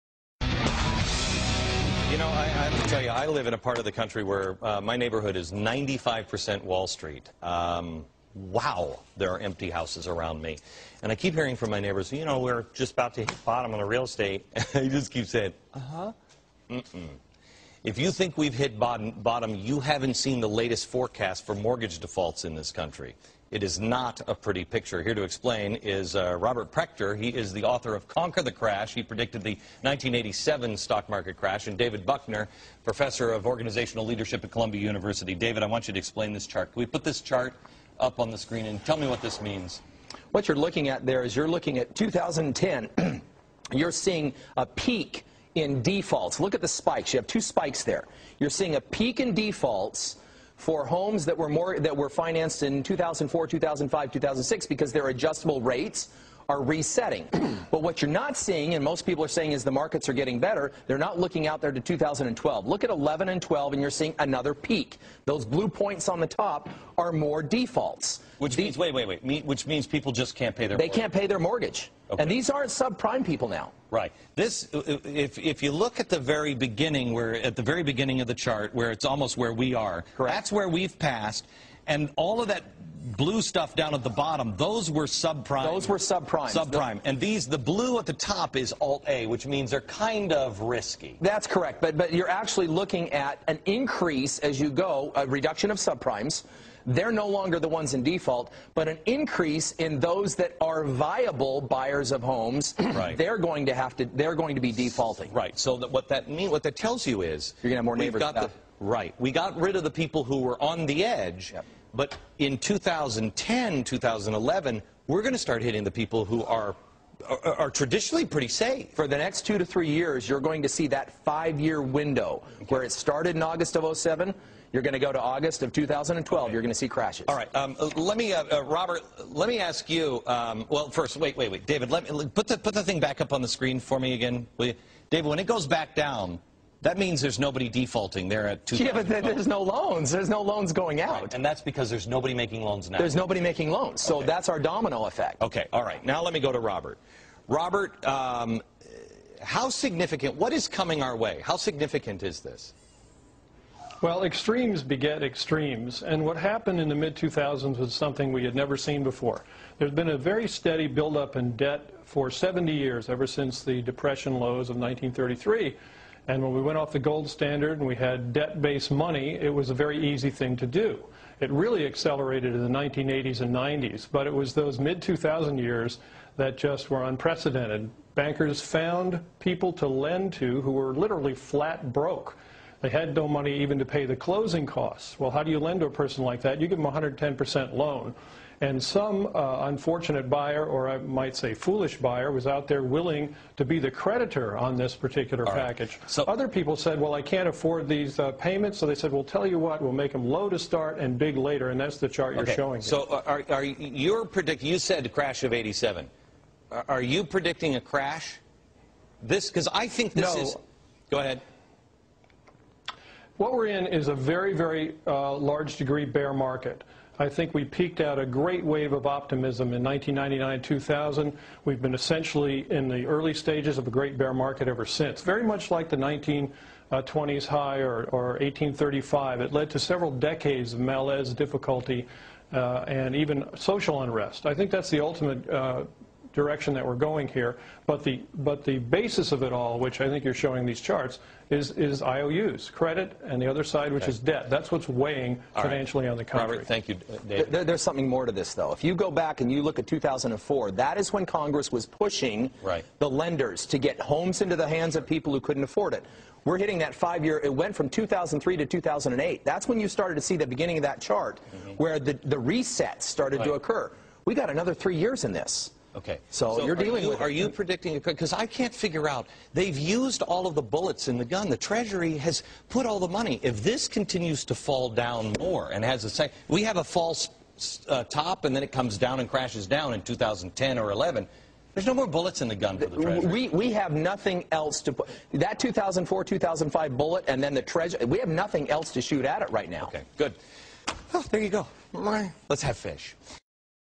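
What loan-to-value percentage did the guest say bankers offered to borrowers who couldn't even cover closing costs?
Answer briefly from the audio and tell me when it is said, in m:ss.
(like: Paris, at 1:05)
110%, at 3:06.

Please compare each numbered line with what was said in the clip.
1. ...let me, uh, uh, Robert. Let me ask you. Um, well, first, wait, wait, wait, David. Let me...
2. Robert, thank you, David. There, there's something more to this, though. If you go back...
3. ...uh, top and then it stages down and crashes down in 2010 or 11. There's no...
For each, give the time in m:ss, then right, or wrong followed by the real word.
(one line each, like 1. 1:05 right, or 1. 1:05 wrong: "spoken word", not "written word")
1. 2:07 right
2. 4:06 right
3. 4:37 wrong: "comes", not "stages".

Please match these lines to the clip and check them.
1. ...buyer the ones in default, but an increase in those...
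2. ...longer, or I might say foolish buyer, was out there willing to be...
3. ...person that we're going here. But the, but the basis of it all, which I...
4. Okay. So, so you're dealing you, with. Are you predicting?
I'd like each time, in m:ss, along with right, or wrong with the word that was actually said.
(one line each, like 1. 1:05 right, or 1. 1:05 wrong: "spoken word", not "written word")
1. 1:37 wrong: "longer", not "buyer"
2. 3:10 wrong: "buyer", not "longer"
3. 3:56 wrong: "direction", not "person"
4. 4:25 right.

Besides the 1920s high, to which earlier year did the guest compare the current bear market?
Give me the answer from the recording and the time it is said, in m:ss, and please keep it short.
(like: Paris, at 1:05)
1835, at 3:48.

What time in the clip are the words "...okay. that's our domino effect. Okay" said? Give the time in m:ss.
2:24.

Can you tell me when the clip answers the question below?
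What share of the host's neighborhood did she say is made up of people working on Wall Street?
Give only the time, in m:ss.
0:05.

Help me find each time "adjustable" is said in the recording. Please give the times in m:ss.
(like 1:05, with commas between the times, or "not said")
0:55.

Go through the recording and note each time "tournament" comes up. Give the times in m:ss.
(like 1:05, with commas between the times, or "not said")
not said.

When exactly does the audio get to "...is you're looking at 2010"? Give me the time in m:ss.
0:41.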